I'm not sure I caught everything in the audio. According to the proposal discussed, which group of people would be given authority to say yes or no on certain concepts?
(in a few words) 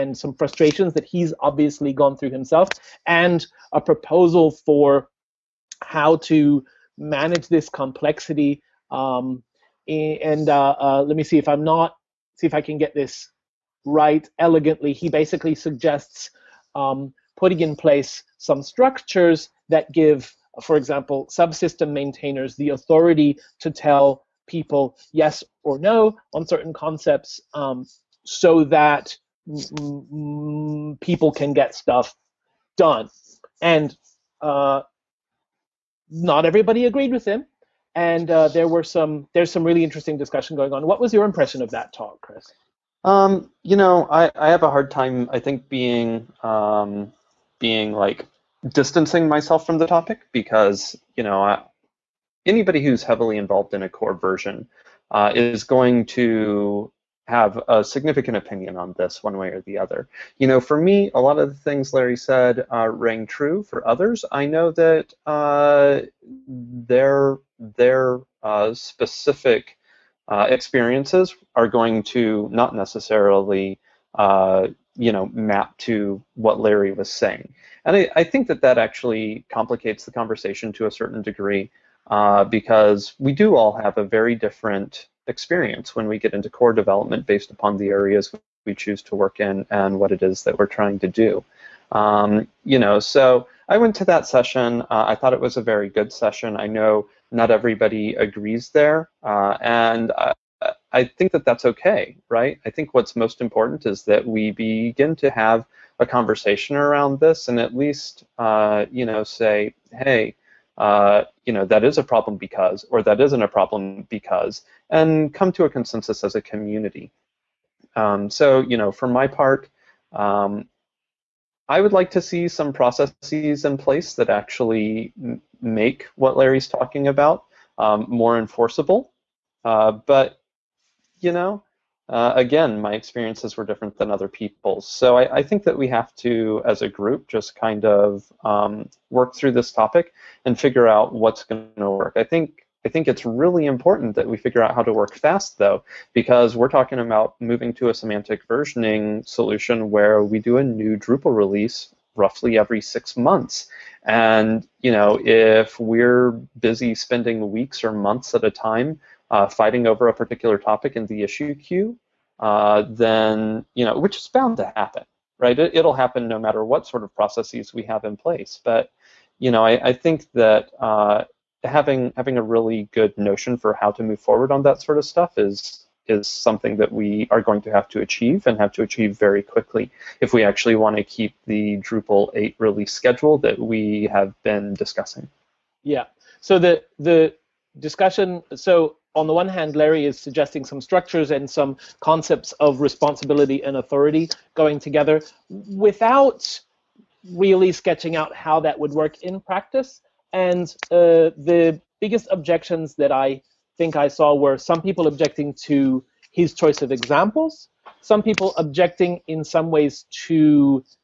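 subsystem maintainers.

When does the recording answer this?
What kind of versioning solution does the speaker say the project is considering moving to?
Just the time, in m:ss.
2:27.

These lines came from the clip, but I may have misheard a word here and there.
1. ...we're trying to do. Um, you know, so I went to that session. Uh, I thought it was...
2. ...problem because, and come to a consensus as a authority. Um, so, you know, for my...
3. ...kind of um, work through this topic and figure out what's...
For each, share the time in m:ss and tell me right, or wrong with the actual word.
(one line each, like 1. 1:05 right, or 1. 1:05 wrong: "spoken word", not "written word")
1. 1:30 right
2. 1:53 wrong: "community", not "authority"
3. 2:17 right.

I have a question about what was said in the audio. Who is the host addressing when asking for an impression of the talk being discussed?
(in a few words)
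Kris.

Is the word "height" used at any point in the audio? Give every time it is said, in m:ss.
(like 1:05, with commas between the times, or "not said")
not said.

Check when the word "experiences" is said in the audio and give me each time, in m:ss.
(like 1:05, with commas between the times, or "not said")
1:10, 1:25, 2:12.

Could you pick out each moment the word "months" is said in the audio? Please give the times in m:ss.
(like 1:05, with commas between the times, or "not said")
2:33, 2:37.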